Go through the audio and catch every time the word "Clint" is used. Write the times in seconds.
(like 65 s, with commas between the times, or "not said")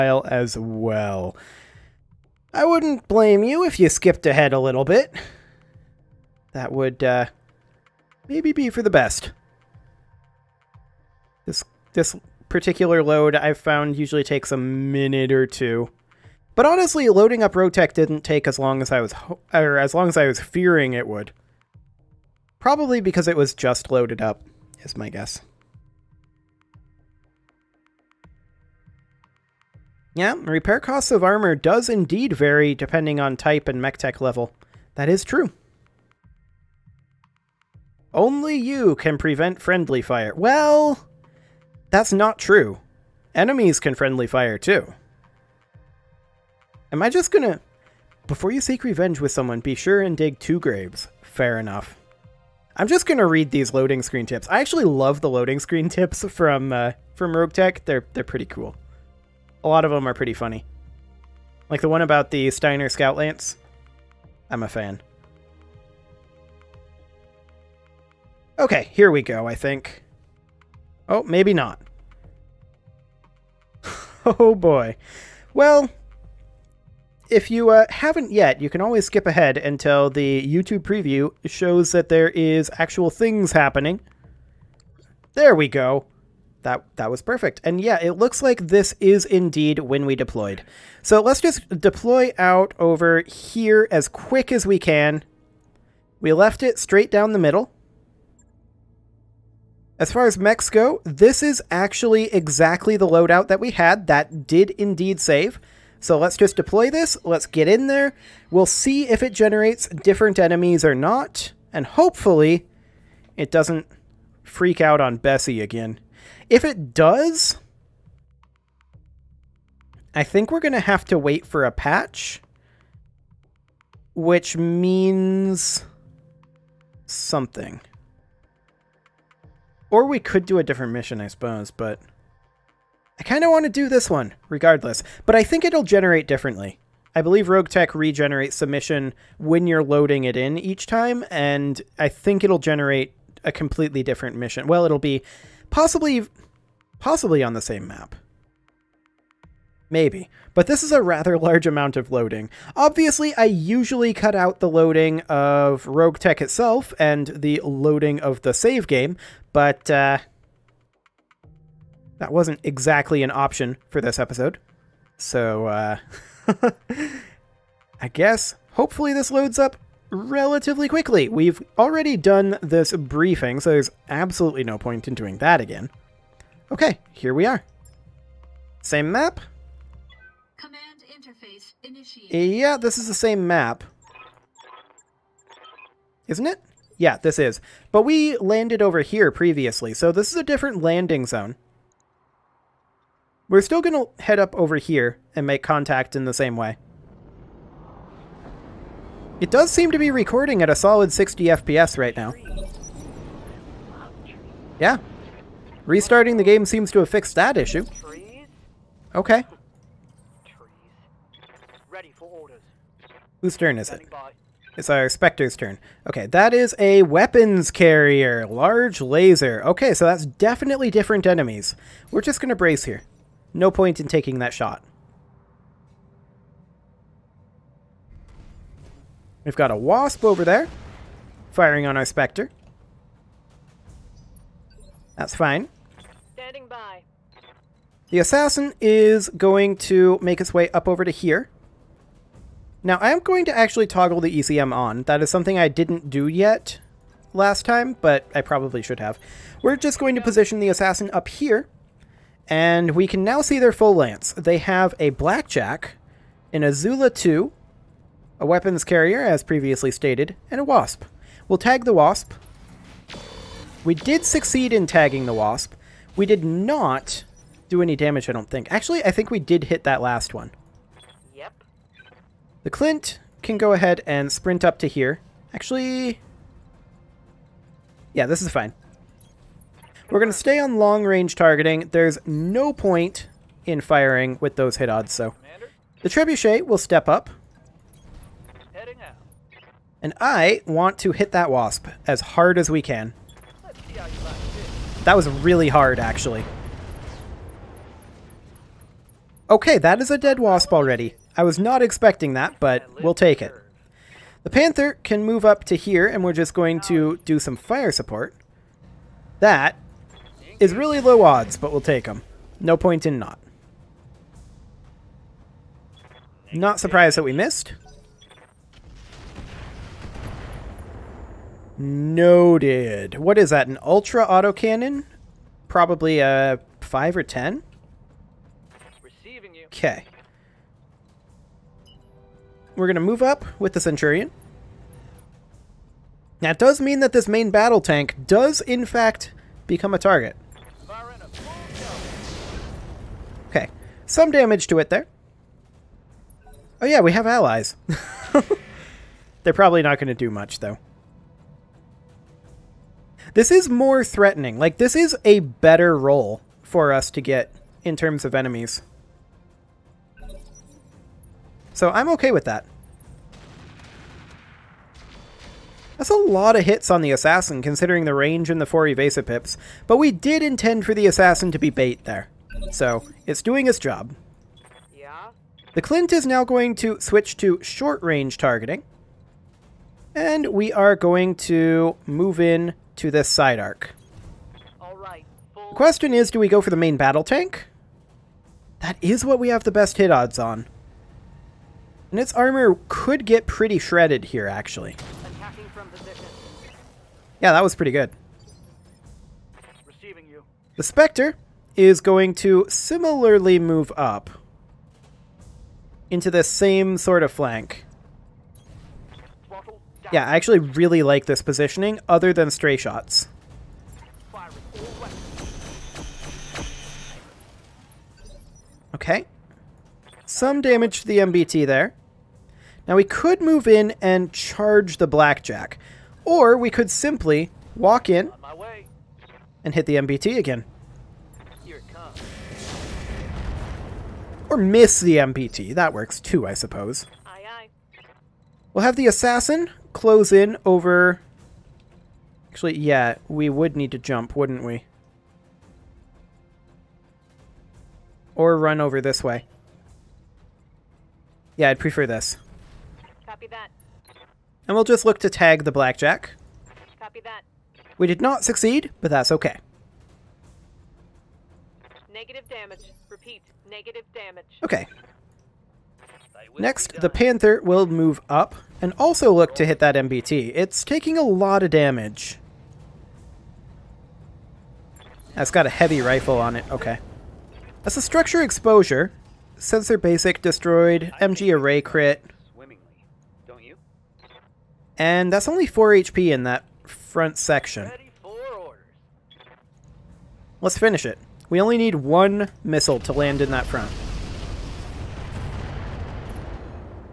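272 s, 375 s.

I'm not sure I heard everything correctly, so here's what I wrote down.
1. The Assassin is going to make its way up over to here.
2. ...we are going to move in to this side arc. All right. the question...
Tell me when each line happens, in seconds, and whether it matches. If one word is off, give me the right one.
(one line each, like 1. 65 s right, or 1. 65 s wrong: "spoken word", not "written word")
1. 238 s right
2. 380 s right.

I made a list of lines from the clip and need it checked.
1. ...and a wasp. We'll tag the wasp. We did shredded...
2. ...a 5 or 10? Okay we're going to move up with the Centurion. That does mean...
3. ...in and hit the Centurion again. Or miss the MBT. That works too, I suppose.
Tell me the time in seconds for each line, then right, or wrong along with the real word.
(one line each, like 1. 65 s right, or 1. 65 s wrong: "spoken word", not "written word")
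1. 260 s wrong: "succeed", not "shredded"
2. 326 s right
3. 428 s wrong: "MBT", not "Centurion".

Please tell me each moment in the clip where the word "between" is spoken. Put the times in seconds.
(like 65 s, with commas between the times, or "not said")
not said.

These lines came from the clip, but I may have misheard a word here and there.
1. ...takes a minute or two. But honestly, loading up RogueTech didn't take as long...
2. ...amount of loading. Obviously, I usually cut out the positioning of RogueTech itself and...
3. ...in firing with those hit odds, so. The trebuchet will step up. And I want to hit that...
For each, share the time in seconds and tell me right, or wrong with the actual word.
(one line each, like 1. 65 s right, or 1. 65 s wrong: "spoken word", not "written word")
1. 14 s right
2. 151 s wrong: "loading", not "positioning"
3. 283 s right.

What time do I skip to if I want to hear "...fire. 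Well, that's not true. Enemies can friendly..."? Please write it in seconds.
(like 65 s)
40 s.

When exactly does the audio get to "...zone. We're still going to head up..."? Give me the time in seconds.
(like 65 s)
191 s.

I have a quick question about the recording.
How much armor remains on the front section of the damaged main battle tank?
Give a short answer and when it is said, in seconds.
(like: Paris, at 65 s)
4 HP, at 485 s.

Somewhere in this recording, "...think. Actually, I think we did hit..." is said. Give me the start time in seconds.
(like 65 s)
268 s.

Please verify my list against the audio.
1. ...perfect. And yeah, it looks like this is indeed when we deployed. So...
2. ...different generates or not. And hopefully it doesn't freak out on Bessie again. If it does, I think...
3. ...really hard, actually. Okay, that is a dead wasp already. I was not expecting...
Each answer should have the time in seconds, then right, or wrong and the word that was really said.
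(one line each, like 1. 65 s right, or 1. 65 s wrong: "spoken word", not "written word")
1. 87 s right
2. 109 s wrong: "enemies", not "generates"
3. 295 s right.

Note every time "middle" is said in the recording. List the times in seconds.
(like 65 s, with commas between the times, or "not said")
97 s.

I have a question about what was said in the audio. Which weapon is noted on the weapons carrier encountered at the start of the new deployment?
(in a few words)
Large laser.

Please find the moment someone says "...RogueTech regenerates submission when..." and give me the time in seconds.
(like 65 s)
137 s.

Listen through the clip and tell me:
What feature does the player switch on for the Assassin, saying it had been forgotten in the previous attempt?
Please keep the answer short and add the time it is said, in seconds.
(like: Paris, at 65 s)
ECM, at 244 s.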